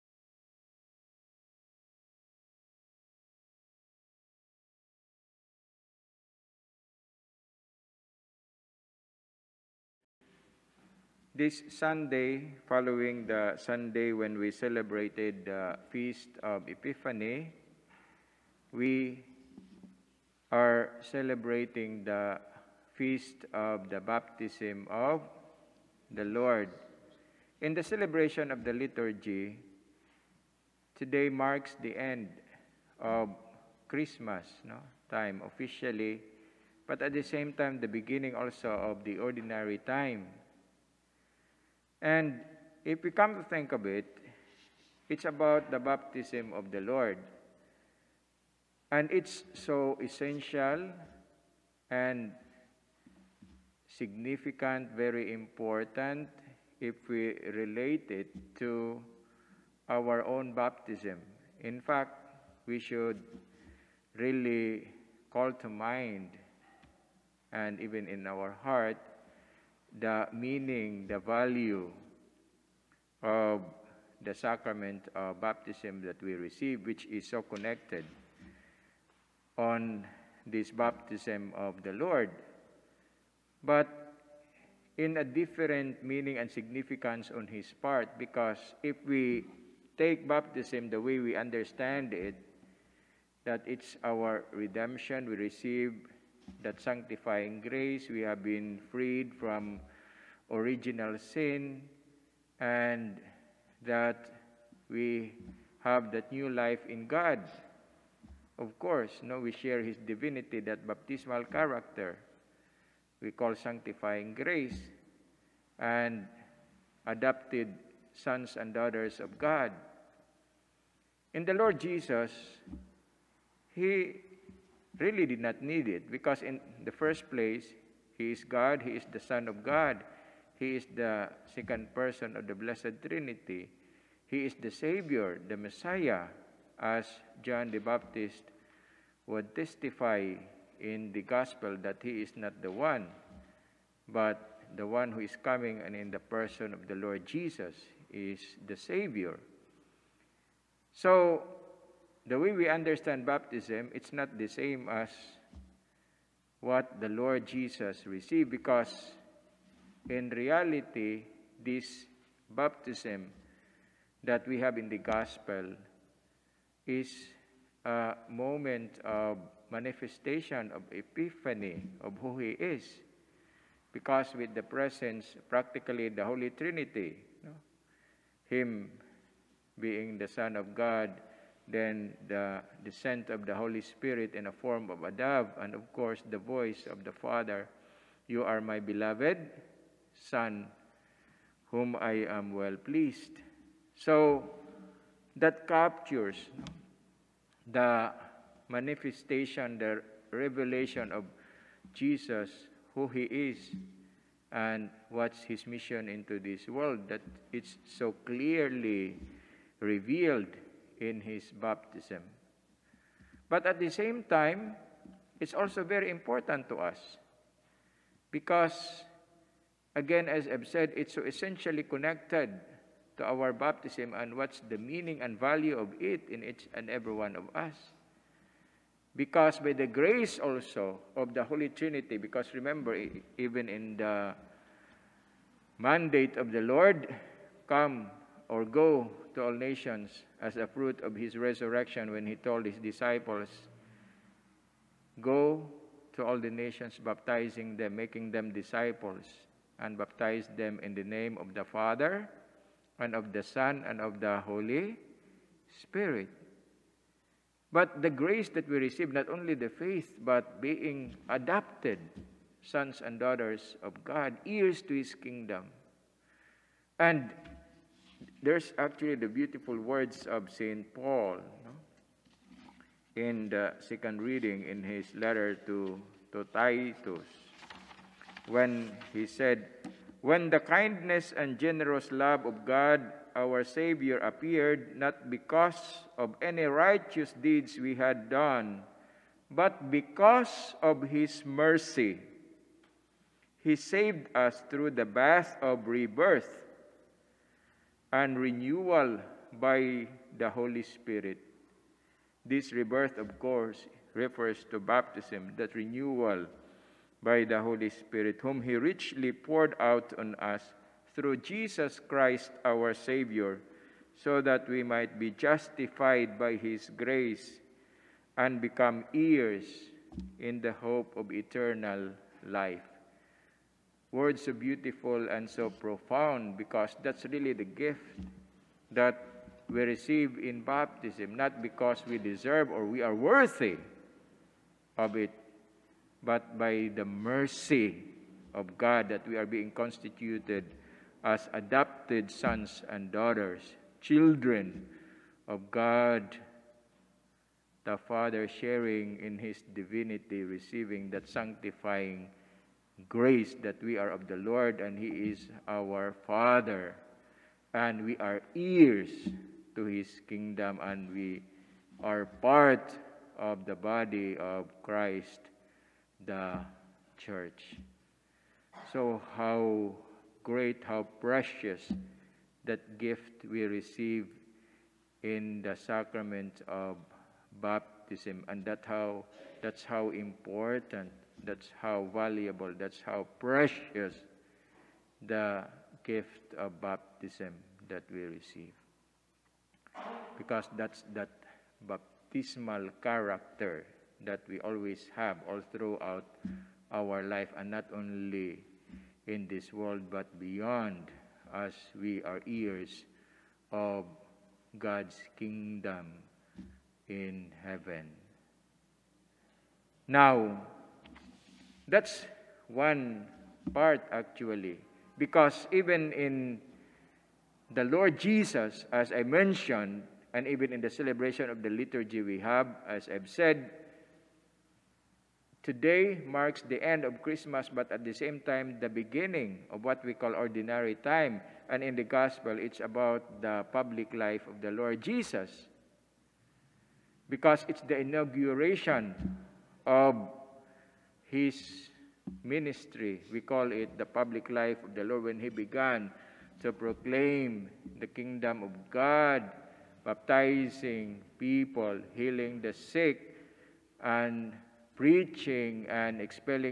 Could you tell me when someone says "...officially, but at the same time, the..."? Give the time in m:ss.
0:35.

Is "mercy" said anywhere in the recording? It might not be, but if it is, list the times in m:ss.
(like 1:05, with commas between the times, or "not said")
4:51, 5:37.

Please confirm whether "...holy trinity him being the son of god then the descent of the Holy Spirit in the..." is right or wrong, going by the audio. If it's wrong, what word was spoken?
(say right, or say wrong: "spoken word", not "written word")
right.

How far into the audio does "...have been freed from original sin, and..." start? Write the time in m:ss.
1:38.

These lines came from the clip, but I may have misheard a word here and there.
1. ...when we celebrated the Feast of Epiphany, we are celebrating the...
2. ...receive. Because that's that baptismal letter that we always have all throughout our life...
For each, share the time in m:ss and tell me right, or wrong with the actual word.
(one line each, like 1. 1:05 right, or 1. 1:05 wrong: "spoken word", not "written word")
1. 0:14 right
2. 6:28 wrong: "character", not "letter".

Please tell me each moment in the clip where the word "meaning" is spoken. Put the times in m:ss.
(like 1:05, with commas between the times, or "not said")
1:10, 1:26, 3:44.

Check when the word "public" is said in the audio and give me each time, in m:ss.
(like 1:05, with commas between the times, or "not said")
7:13, 7:24.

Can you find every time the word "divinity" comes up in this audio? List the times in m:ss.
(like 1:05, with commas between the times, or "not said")
1:50, 5:49.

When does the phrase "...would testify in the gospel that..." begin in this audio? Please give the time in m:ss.
2:19.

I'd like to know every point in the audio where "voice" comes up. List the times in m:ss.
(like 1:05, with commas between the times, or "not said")
3:06.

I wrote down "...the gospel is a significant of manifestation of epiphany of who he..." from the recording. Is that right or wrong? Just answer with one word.
wrong.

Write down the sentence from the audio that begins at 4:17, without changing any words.
But the grace that we receive, not only the faith, but being adopted sons and daughters of God, ears to his kingdom.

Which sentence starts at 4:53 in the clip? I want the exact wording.
He saved us through the bath of rebirth and renewal by the Holy Spirit.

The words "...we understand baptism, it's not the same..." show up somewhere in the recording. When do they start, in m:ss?
2:32.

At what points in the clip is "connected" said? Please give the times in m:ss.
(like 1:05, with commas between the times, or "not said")
1:17, 3:41.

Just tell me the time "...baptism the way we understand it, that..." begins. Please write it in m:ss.
1:30.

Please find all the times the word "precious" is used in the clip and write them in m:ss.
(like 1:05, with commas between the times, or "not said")
6:11, 6:23.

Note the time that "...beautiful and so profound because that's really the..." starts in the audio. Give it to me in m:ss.
5:24.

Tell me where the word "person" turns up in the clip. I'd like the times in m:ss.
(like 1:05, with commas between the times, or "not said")
2:11, 2:26.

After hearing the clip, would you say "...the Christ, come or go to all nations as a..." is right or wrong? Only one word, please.
wrong.